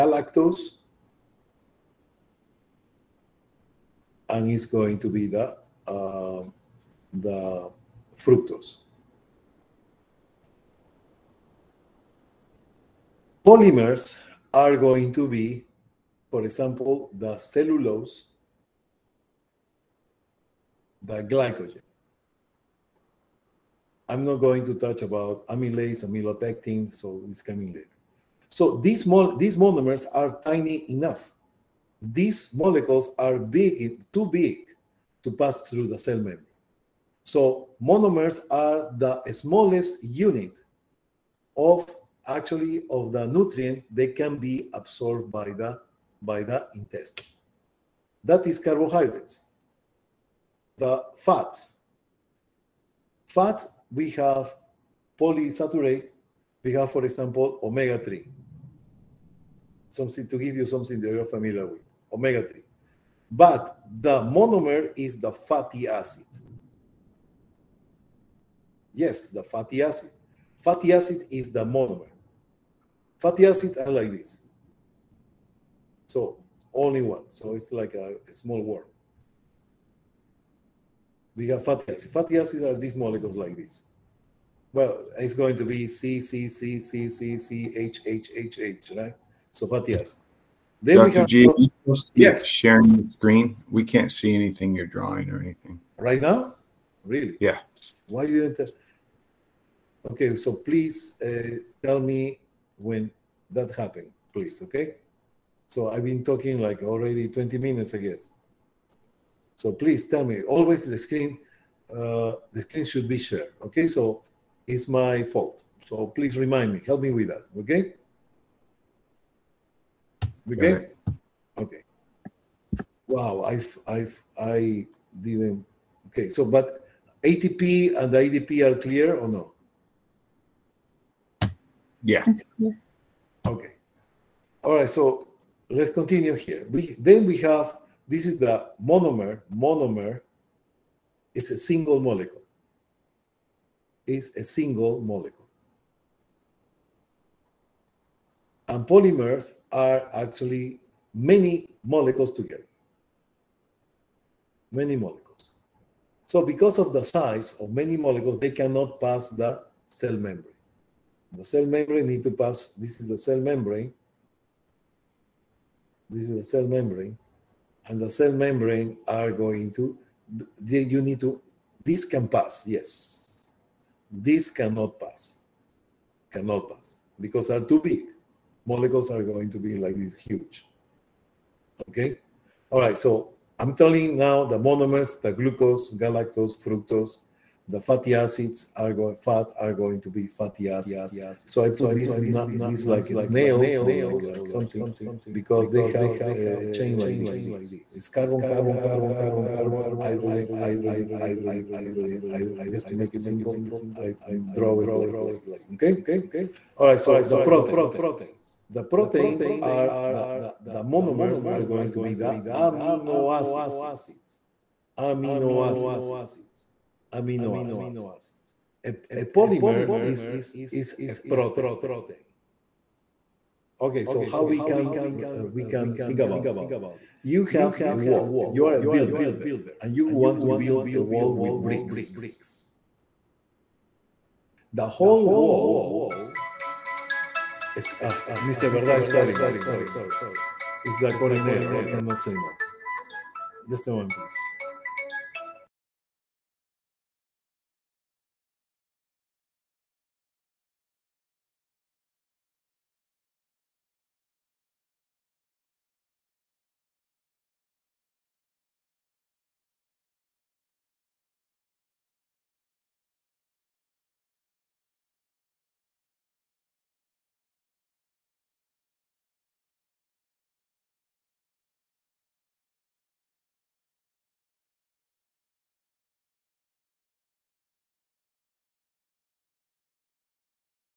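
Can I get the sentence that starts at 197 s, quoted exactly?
It's carbon, carbon, carbon, carbon, carbon, hydrogen, hydrogen, hydrogen, hydrogen, hydrogen.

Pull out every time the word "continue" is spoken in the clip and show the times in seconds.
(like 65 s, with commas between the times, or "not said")
135 s.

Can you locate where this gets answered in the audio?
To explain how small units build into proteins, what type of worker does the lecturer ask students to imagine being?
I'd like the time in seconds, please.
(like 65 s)
228 s.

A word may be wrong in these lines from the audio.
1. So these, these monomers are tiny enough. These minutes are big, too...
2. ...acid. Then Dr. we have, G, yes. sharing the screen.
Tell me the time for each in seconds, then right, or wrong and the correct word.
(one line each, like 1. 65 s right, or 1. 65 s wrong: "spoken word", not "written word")
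1. 28 s wrong: "molecules", not "minutes"
2. 89 s right.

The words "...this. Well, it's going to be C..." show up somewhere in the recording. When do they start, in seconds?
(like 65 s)
83 s.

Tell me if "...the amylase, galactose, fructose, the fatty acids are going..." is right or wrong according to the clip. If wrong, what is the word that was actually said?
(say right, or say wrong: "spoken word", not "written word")
wrong: "glucose", not "amylase".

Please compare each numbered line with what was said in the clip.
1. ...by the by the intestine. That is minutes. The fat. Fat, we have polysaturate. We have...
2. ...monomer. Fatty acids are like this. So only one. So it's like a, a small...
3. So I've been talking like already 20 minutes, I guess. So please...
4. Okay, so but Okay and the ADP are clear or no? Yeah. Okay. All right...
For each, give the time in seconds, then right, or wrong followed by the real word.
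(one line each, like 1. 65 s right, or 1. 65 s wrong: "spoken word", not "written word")
1. 45 s wrong: "carbohydrates", not "minutes"
2. 71 s right
3. 105 s right
4. 126 s wrong: "ATP", not "Okay".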